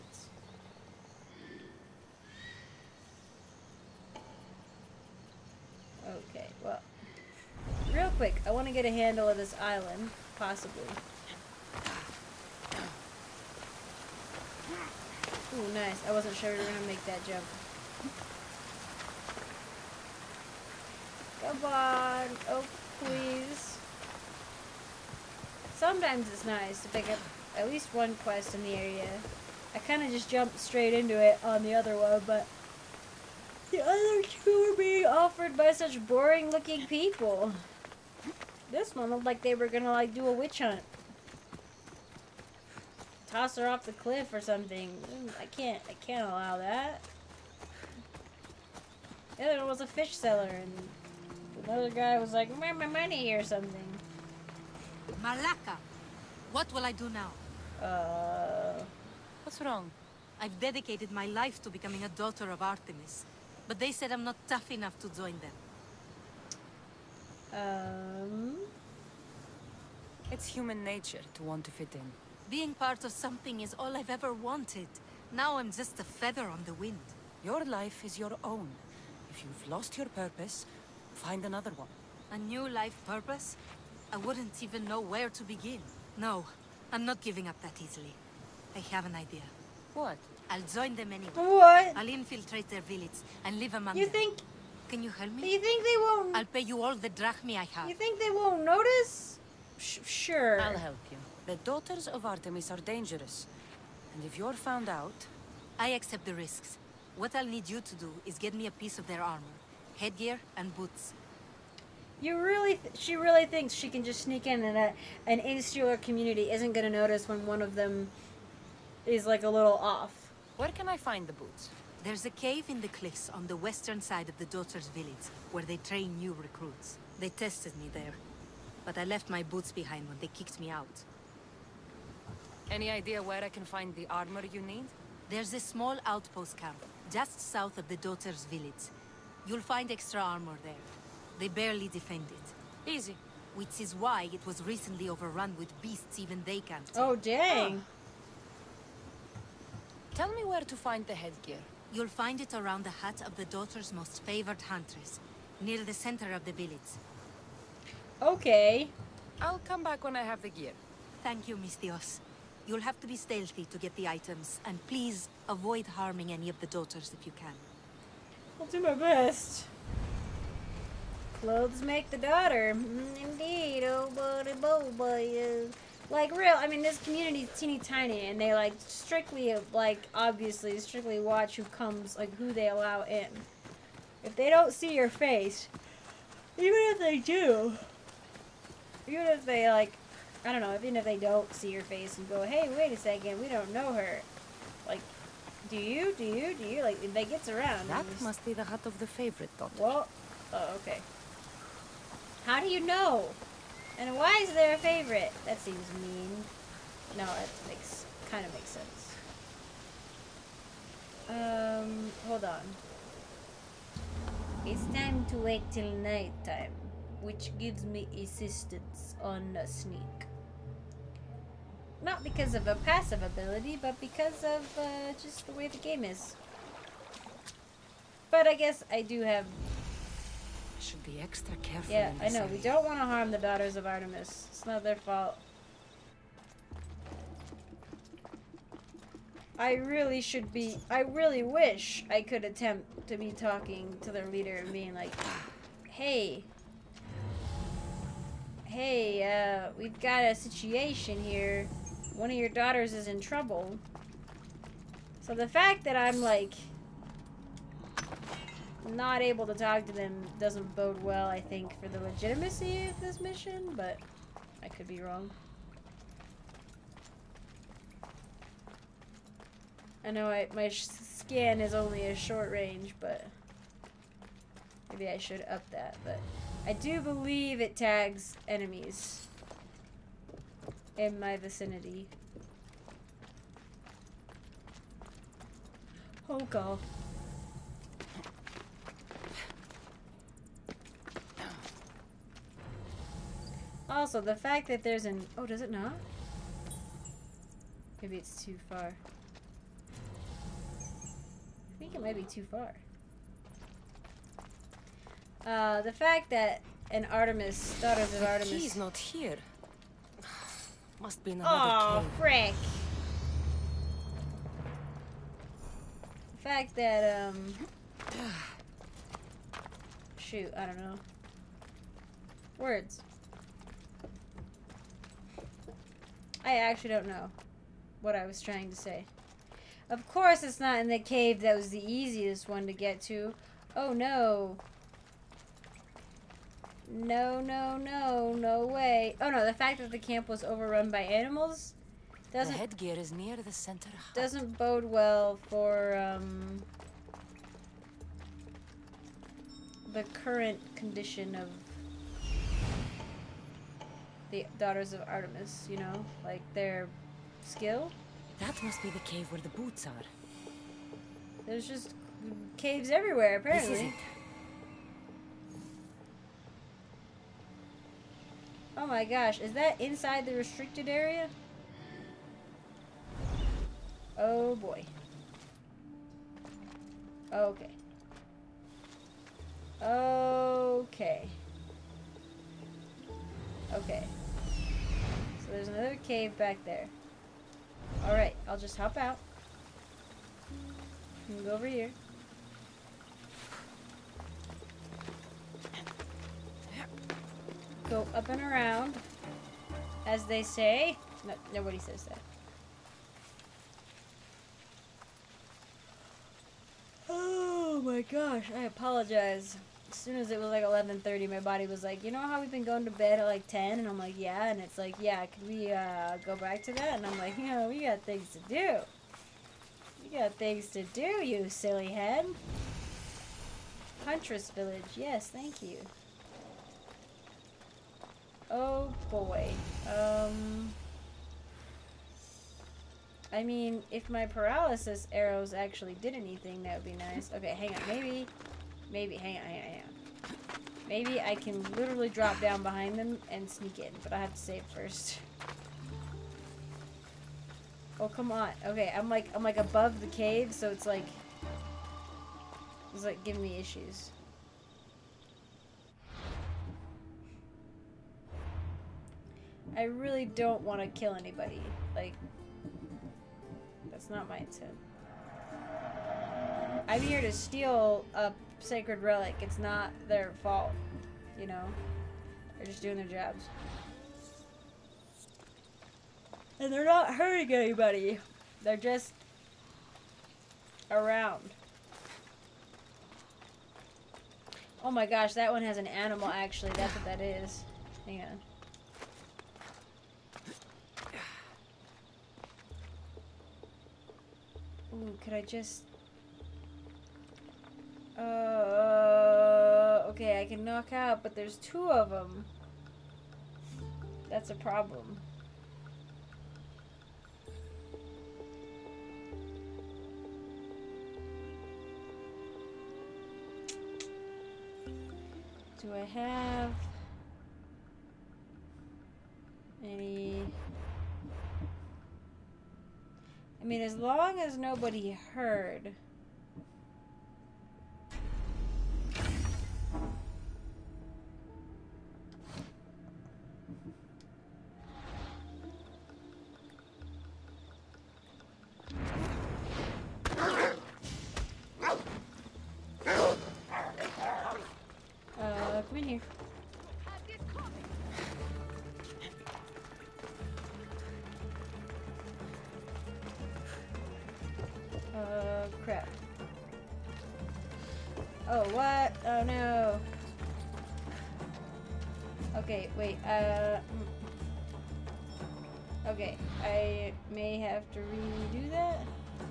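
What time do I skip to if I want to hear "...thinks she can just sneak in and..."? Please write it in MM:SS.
01:53.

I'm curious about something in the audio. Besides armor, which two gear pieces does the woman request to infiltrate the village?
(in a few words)
Headgear and boots.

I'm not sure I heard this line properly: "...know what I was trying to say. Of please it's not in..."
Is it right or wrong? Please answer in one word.
wrong.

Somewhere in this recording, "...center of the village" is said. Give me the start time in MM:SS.
02:35.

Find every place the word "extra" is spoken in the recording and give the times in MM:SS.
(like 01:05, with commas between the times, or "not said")
02:19, 03:51.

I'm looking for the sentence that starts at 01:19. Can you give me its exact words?
If you've lost your purpose, find another one.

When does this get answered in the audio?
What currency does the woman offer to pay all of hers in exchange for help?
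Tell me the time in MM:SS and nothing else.
01:37.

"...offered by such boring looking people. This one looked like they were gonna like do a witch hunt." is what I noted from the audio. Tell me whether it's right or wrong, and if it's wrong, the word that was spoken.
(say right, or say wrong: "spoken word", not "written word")
right.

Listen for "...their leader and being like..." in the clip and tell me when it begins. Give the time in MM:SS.
04:04.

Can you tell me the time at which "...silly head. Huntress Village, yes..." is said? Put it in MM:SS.
07:01.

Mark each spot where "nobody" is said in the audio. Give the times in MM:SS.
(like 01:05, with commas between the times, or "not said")
06:41, 08:44.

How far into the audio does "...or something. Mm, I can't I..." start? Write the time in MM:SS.
00:44.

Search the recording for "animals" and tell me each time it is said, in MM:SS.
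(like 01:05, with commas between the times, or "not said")
05:41, 08:05.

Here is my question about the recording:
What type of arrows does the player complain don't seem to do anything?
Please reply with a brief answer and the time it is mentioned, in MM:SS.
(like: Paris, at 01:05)
paralysis arrows, at 07:14.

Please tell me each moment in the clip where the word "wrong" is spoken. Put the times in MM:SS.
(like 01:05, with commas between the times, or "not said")
00:59, 04:25.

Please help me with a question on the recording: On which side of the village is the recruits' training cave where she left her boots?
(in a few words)
western side.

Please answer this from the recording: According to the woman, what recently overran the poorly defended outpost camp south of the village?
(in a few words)
beasts.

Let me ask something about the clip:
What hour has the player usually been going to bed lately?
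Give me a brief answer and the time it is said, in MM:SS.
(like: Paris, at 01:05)
10, at 06:53.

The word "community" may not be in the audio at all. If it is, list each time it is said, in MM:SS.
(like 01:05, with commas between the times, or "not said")
01:56, 02:56.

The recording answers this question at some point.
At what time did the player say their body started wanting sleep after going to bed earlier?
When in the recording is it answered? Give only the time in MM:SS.
06:50.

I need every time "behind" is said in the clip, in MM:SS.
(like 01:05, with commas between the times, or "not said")
02:09, 07:22.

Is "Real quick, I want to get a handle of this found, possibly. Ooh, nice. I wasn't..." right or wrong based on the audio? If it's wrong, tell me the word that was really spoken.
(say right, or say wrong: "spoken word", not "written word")
wrong: "island", not "found".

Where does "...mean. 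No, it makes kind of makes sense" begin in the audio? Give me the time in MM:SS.
03:26.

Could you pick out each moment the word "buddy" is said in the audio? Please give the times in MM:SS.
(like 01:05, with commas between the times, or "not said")
02:54.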